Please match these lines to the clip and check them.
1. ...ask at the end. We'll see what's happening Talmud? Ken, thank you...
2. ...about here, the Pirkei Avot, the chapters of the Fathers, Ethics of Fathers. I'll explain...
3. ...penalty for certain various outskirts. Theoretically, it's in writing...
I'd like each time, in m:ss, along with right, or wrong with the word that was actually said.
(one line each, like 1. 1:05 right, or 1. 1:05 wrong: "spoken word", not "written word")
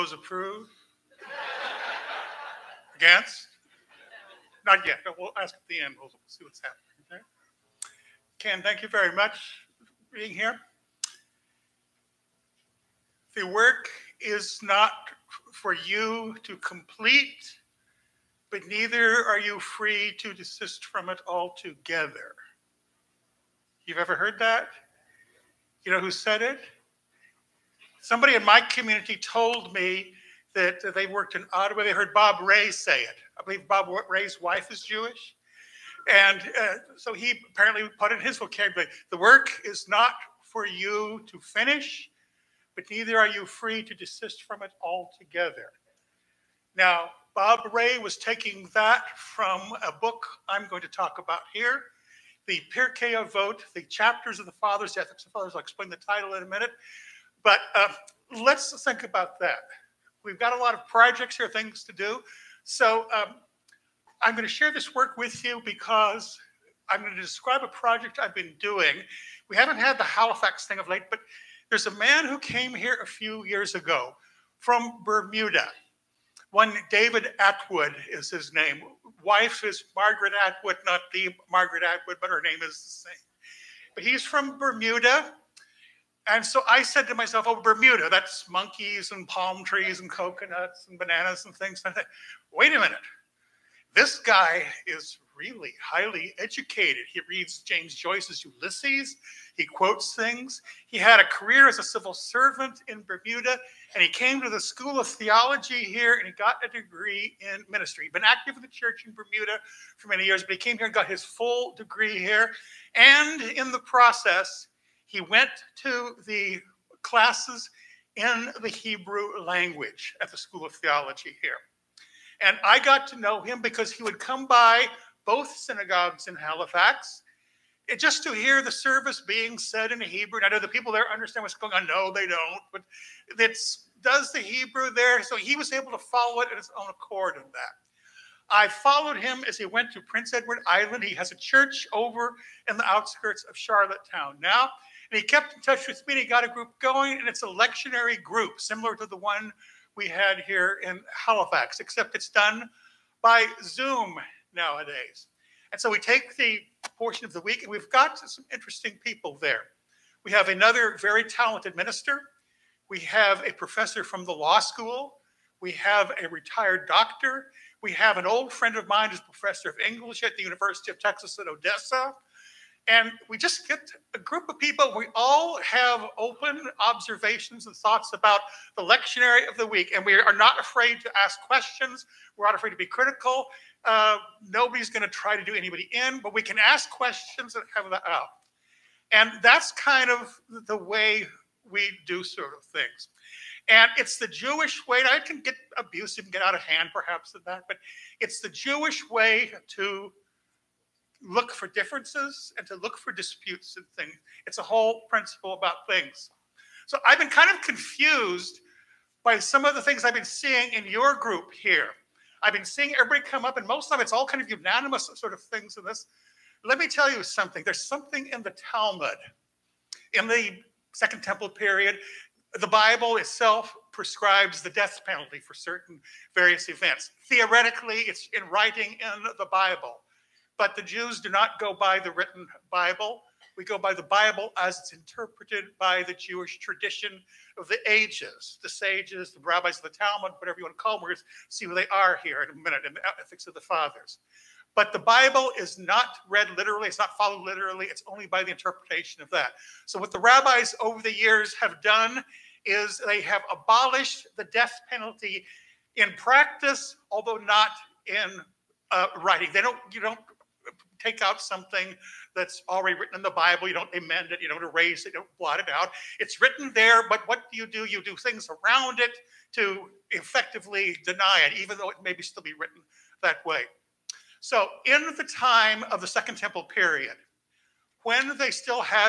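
1. 0:05 wrong: "Okay", not "Talmud"
2. 0:51 right
3. 3:45 wrong: "events", not "outskirts".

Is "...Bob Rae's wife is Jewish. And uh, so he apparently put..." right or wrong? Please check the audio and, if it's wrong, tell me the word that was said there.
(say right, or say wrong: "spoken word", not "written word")
right.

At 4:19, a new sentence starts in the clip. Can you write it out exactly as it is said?
They don't, you don't take out something that's already written in the Bible.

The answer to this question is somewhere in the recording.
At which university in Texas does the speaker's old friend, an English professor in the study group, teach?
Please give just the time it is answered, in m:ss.
2:50.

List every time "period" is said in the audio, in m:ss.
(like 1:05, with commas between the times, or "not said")
3:41, 4:36.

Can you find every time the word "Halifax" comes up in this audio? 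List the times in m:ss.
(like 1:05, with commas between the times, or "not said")
1:10, 2:06, 2:31.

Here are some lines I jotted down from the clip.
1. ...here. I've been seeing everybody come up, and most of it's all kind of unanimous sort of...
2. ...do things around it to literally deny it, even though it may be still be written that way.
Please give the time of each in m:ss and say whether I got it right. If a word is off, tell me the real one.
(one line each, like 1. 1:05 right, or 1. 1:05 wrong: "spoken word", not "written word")
1. 3:31 right
2. 4:28 wrong: "effectively", not "literally".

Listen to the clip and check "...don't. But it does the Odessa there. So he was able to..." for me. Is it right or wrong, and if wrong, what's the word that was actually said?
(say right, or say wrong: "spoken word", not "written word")
wrong: "Hebrew", not "Odessa".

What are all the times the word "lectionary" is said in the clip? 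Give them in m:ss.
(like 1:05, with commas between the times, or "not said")
2:27, 2:58.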